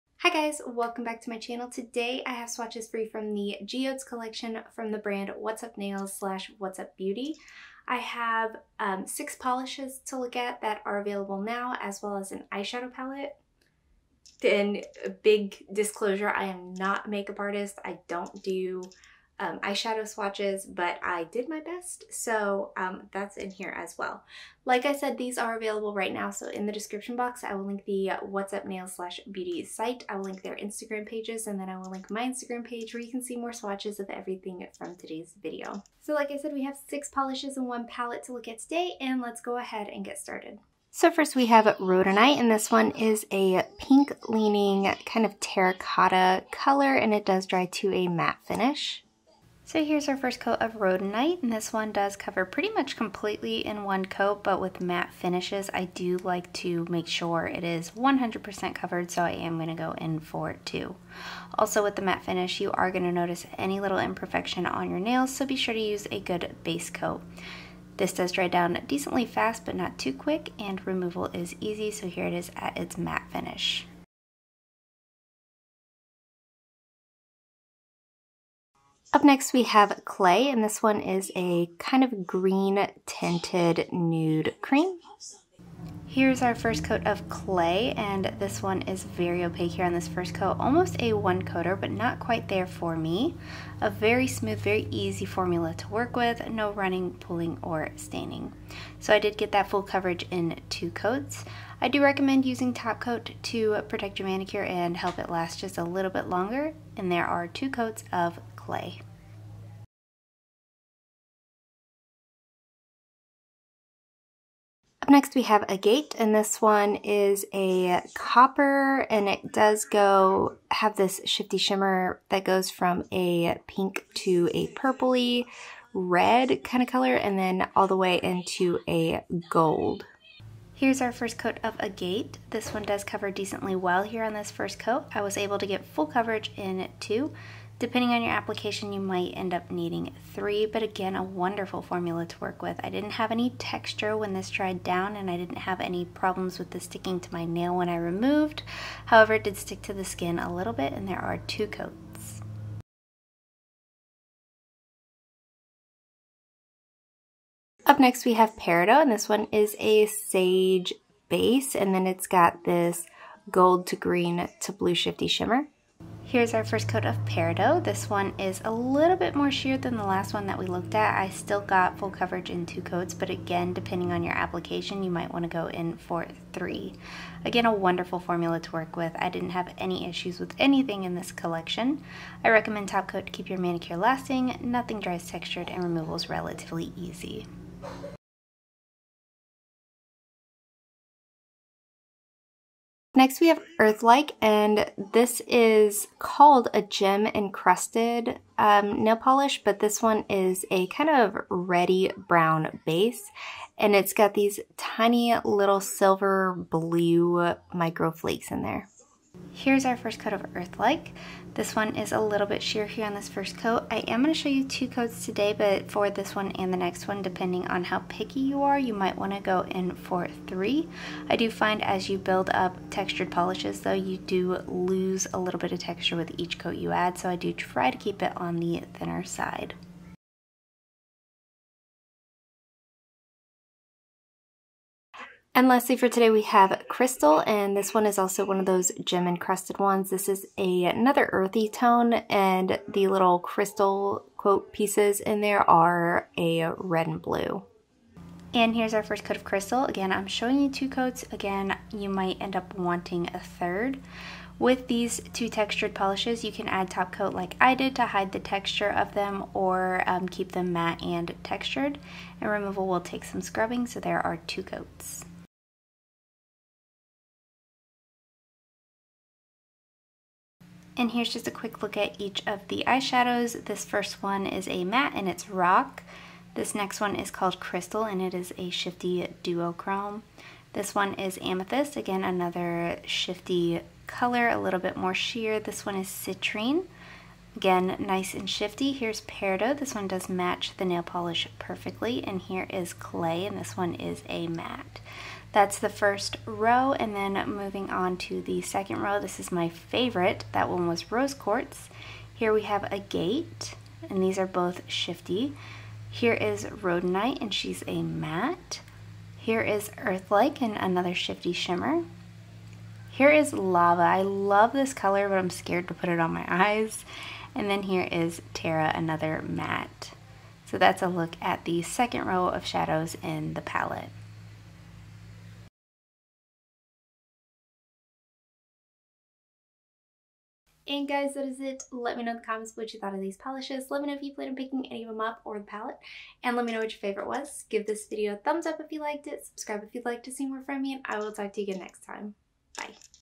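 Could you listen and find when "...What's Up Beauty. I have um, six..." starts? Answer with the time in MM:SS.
00:06.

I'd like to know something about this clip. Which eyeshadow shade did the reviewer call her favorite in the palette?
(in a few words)
Rose Quartz.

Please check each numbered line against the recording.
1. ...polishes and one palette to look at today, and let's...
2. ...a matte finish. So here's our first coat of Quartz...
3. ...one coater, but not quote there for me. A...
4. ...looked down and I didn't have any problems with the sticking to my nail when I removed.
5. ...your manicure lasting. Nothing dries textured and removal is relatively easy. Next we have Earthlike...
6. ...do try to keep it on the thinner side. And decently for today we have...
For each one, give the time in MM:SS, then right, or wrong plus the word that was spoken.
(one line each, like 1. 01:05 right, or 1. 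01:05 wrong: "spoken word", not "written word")
1. 00:37 right
2. 00:47 wrong: "Rhodonite", not "Quartz"
3. 01:31 wrong: "quite", not "quote"
4. 02:24 wrong: "dried", not "looked"
5. 03:03 right
6. 03:47 wrong: "lastly", not "decently".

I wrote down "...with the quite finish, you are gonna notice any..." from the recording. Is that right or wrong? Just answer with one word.
wrong.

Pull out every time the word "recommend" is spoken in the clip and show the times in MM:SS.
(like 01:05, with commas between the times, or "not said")
01:42, 03:02.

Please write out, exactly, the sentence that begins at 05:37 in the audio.
Give this video a thumbs up if you liked it.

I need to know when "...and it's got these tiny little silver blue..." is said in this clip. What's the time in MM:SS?
03:23.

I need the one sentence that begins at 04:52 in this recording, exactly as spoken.
And here is Clay, and this one is a matte.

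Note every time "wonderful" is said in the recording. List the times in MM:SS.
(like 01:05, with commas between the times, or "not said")
02:21, 02:57.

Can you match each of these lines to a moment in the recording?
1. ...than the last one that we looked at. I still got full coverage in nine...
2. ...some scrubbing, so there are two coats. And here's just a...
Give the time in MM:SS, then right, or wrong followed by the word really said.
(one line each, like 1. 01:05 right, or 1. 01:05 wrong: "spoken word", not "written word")
1. 02:49 wrong: "two", not "nine"
2. 04:23 right.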